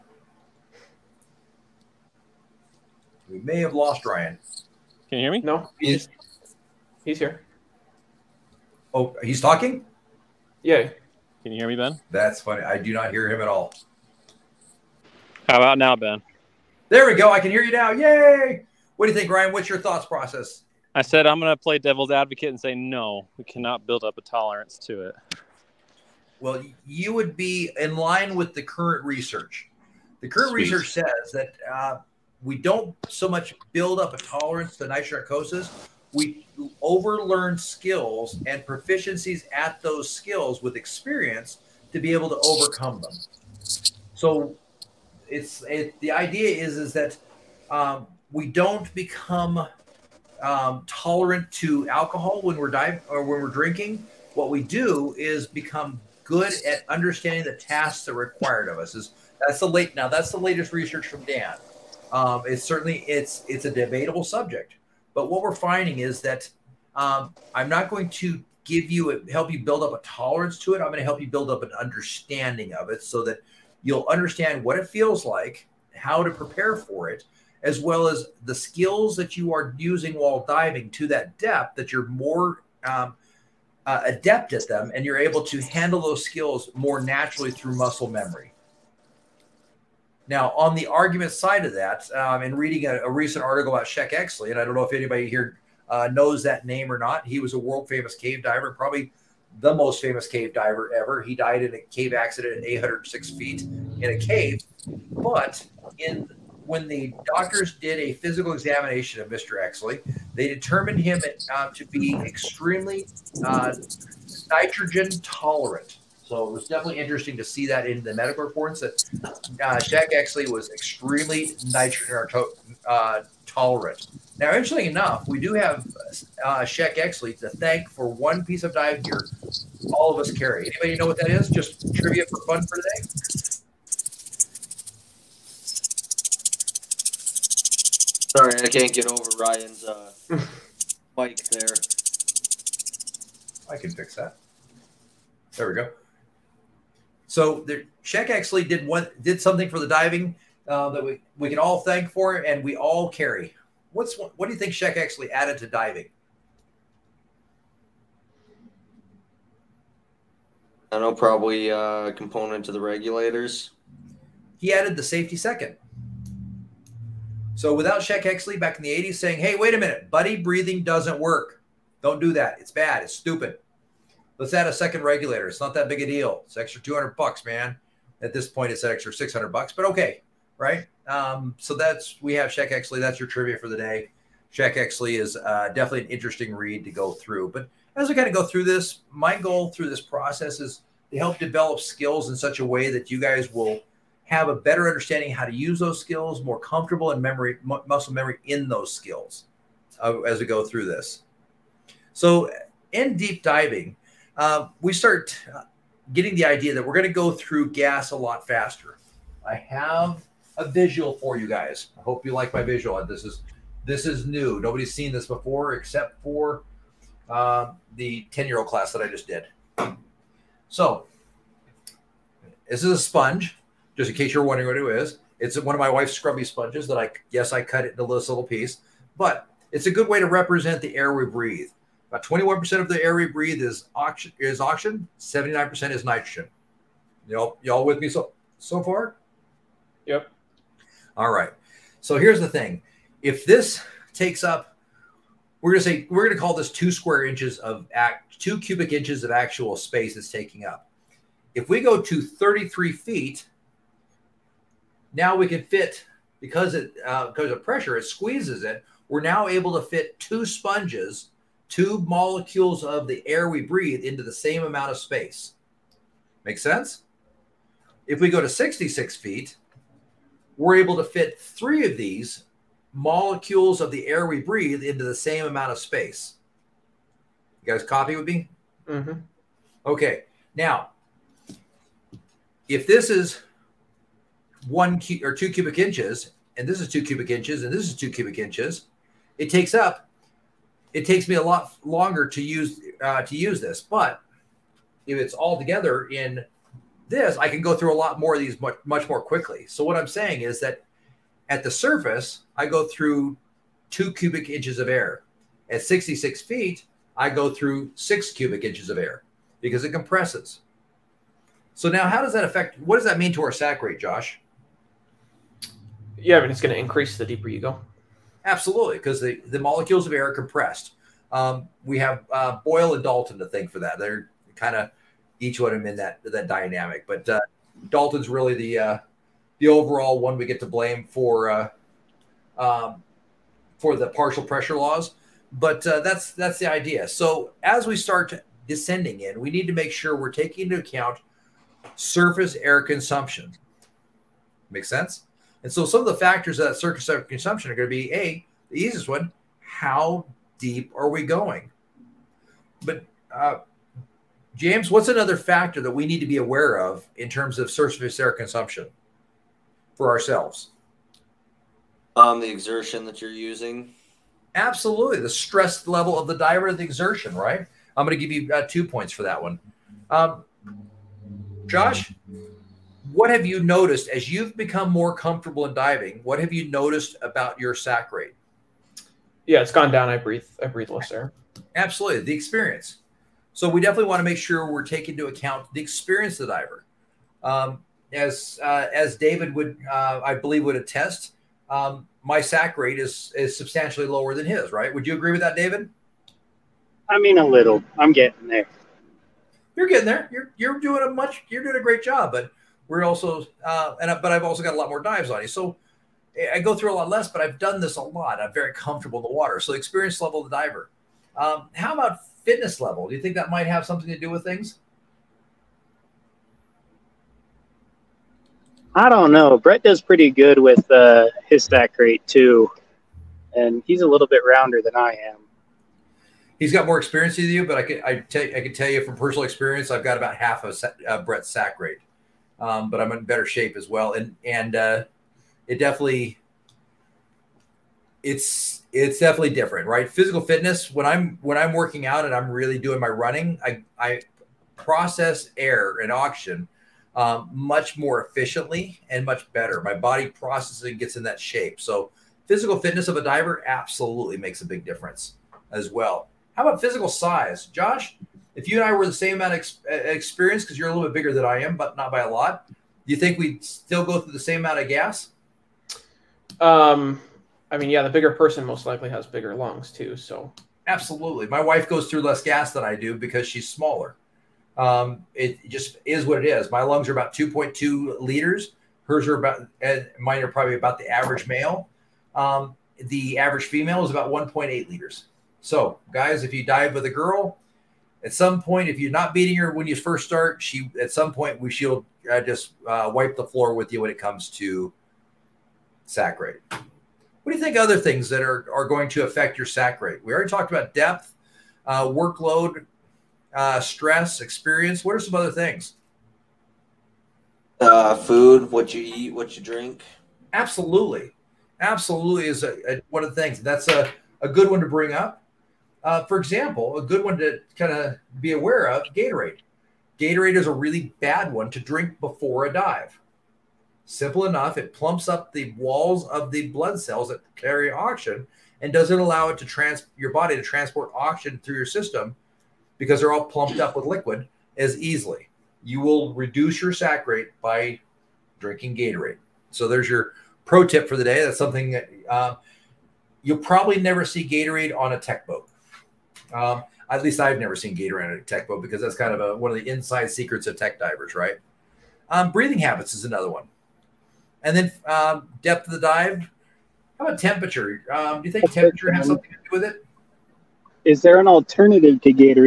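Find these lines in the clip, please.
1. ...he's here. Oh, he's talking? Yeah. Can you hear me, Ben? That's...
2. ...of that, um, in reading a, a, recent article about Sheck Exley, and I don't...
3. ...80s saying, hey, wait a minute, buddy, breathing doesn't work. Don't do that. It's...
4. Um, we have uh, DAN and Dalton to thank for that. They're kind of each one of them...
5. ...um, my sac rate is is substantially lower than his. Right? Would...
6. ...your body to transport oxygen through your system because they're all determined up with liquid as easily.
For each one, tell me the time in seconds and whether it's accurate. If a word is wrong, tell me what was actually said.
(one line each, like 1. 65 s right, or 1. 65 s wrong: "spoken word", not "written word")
1. 7 s right
2. 91 s right
3. 168 s right
4. 321 s wrong: "Boyle", not "DAN"
5. 391 s right
6. 530 s wrong: "plumped", not "determined".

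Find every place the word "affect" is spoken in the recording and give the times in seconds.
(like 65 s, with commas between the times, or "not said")
312 s, 499 s.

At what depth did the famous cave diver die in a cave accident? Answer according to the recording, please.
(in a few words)
806 feet.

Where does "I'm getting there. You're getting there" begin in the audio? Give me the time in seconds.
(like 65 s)
397 s.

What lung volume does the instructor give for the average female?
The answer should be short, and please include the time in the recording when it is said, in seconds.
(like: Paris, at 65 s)
1.8 liters, at 484 s.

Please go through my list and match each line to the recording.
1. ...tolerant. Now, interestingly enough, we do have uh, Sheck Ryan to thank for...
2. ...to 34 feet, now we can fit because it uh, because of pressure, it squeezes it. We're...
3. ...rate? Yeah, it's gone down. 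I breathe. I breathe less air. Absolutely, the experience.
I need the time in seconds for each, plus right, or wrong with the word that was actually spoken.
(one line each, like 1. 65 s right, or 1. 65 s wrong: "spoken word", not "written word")
1. 123 s wrong: "Exley", not "Ryan"
2. 252 s wrong: "33", not "34"
3. 378 s right.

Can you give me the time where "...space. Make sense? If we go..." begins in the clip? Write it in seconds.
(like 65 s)
264 s.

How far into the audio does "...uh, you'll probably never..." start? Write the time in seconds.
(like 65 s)
542 s.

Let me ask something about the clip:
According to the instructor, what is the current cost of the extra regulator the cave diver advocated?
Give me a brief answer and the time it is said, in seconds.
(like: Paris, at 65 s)
600 bucks, at 179 s.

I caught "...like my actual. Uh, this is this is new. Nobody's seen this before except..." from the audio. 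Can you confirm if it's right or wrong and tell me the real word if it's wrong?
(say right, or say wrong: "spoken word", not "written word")
wrong: "visual", not "actual".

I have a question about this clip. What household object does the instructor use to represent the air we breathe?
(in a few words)
A sponge.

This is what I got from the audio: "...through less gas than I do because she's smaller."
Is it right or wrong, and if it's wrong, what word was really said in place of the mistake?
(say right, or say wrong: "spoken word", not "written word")
right.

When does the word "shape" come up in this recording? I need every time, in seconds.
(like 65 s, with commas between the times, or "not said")
433 s, 451 s.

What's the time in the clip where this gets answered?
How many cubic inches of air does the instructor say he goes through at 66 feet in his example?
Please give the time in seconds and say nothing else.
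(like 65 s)
307 s.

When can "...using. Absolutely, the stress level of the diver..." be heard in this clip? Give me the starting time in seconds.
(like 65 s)
363 s.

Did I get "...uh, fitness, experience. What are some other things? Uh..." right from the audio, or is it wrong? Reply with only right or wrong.
wrong.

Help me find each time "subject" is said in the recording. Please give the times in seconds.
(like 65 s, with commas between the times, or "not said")
64 s.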